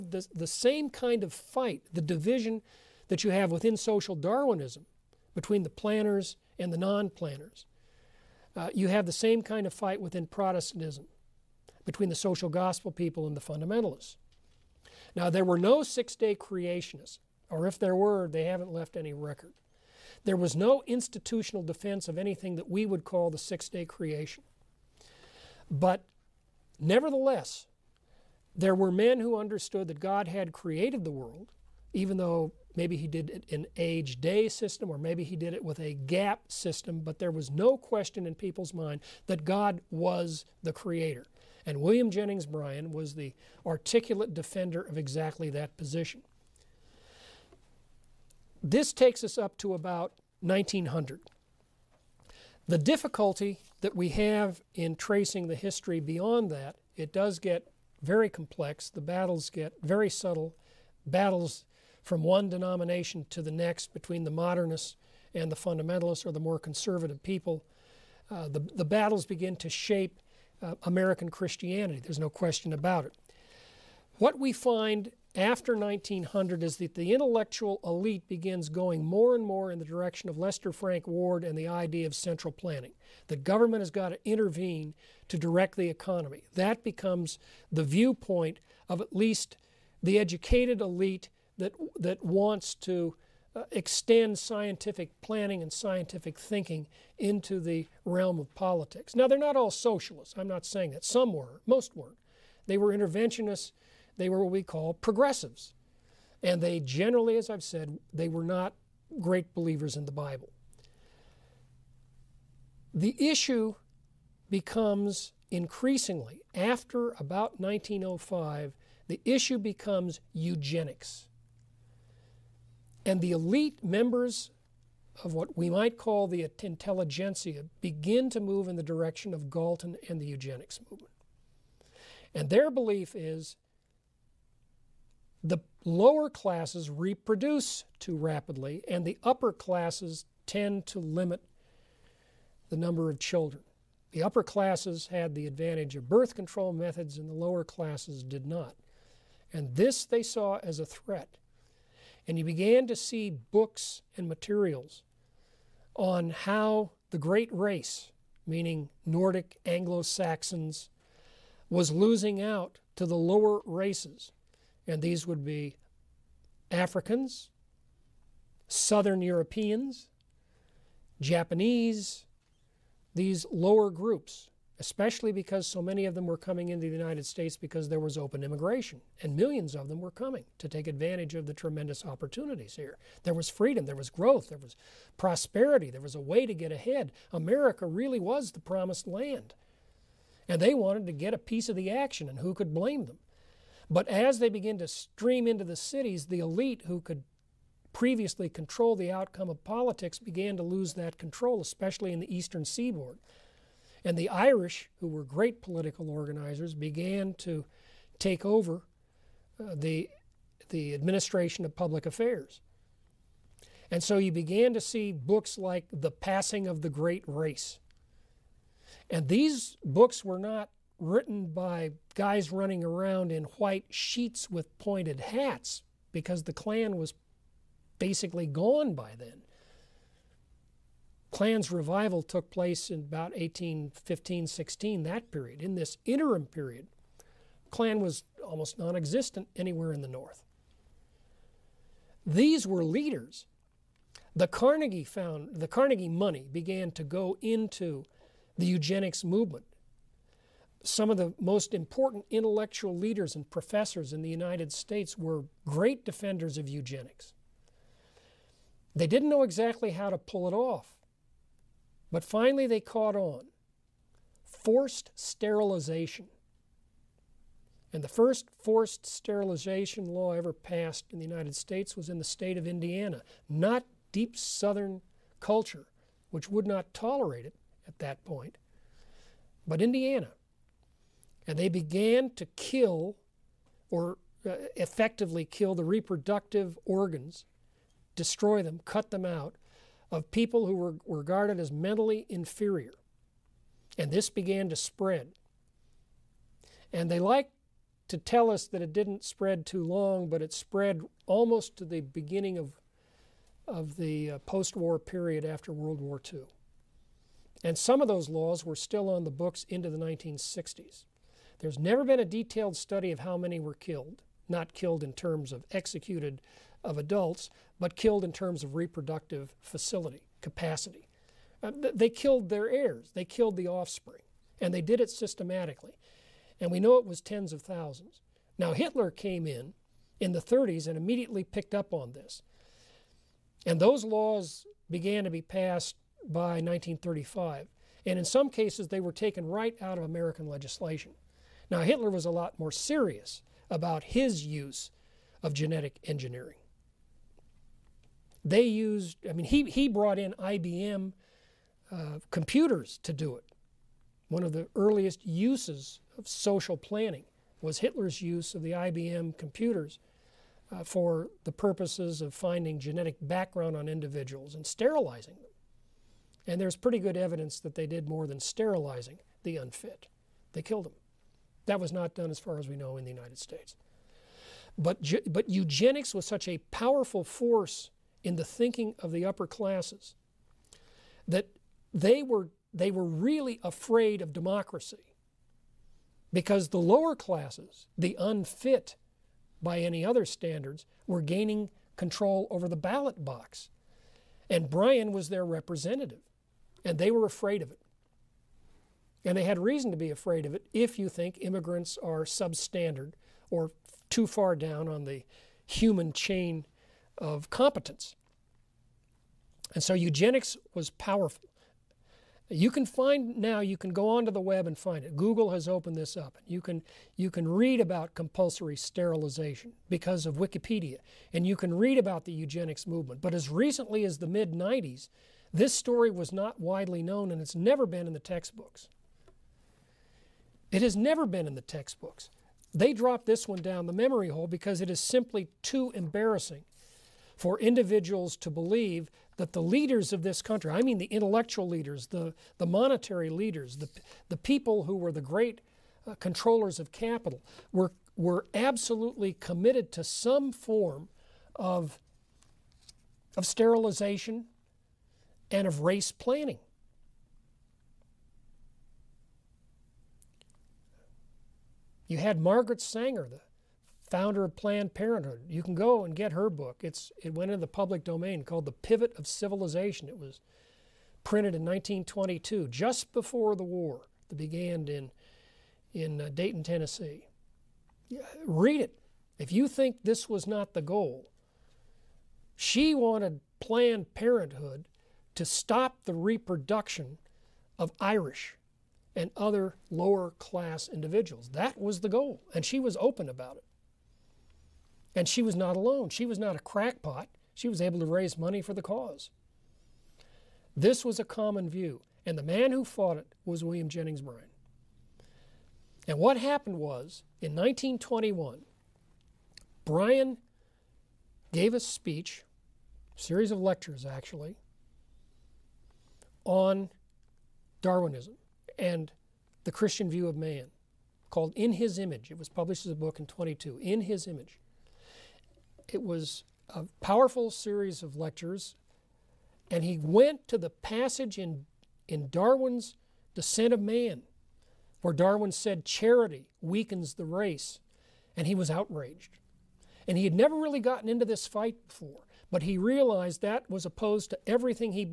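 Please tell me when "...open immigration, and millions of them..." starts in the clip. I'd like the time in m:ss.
2:58.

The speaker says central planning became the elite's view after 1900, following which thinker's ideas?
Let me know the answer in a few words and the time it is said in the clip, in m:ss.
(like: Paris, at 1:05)
Lester Frank Ward, at 1:20.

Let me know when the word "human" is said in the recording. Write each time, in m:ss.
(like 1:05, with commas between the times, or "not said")
6:45.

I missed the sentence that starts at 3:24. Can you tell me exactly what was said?
And the Irish, who were great political organizers, began to take over uh, the, the administration of public affairs.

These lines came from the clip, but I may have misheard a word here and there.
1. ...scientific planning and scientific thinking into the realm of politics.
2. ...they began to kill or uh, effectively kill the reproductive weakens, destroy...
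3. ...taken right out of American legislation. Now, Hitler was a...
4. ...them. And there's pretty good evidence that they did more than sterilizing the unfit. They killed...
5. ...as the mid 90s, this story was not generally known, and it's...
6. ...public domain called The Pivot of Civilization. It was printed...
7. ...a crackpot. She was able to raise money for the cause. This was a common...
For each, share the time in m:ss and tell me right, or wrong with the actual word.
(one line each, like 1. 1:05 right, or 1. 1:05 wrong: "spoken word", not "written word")
1. 1:34 right
2. 4:41 wrong: "organs", not "weakens"
3. 5:39 right
4. 6:05 right
5. 7:04 wrong: "widely", not "generally"
6. 7:47 right
7. 8:16 right.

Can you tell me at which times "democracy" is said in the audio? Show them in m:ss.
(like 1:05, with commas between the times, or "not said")
6:24.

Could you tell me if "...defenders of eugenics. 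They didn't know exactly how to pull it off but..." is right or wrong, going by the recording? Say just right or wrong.
right.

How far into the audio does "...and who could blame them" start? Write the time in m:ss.
3:12.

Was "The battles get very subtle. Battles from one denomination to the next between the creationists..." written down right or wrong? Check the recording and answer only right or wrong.
wrong.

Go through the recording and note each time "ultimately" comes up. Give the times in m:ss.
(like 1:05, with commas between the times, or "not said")
not said.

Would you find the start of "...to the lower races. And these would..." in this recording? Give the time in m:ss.
2:42.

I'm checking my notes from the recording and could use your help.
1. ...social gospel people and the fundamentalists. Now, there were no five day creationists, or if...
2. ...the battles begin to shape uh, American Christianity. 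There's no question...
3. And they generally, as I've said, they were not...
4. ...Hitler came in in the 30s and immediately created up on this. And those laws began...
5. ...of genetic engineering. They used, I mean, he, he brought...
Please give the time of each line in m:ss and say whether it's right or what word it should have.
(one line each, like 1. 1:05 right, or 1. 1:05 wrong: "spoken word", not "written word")
1. 0:12 wrong: "six", not "five"
2. 1:08 right
3. 1:46 right
4. 5:28 wrong: "picked", not "created"
5. 5:45 right.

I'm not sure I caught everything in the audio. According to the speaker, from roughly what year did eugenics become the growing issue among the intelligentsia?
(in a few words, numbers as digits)
1905.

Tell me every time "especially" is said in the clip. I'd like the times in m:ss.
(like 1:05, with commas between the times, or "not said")
2:54, 3:21.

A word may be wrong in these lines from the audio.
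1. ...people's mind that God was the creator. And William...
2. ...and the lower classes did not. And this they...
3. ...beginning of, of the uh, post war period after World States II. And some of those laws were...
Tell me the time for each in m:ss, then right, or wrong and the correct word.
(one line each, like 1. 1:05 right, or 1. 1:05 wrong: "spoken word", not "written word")
1. 0:38 right
2. 2:27 right
3. 5:02 wrong: "War", not "States".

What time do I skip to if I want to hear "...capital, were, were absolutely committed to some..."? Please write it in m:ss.
7:26.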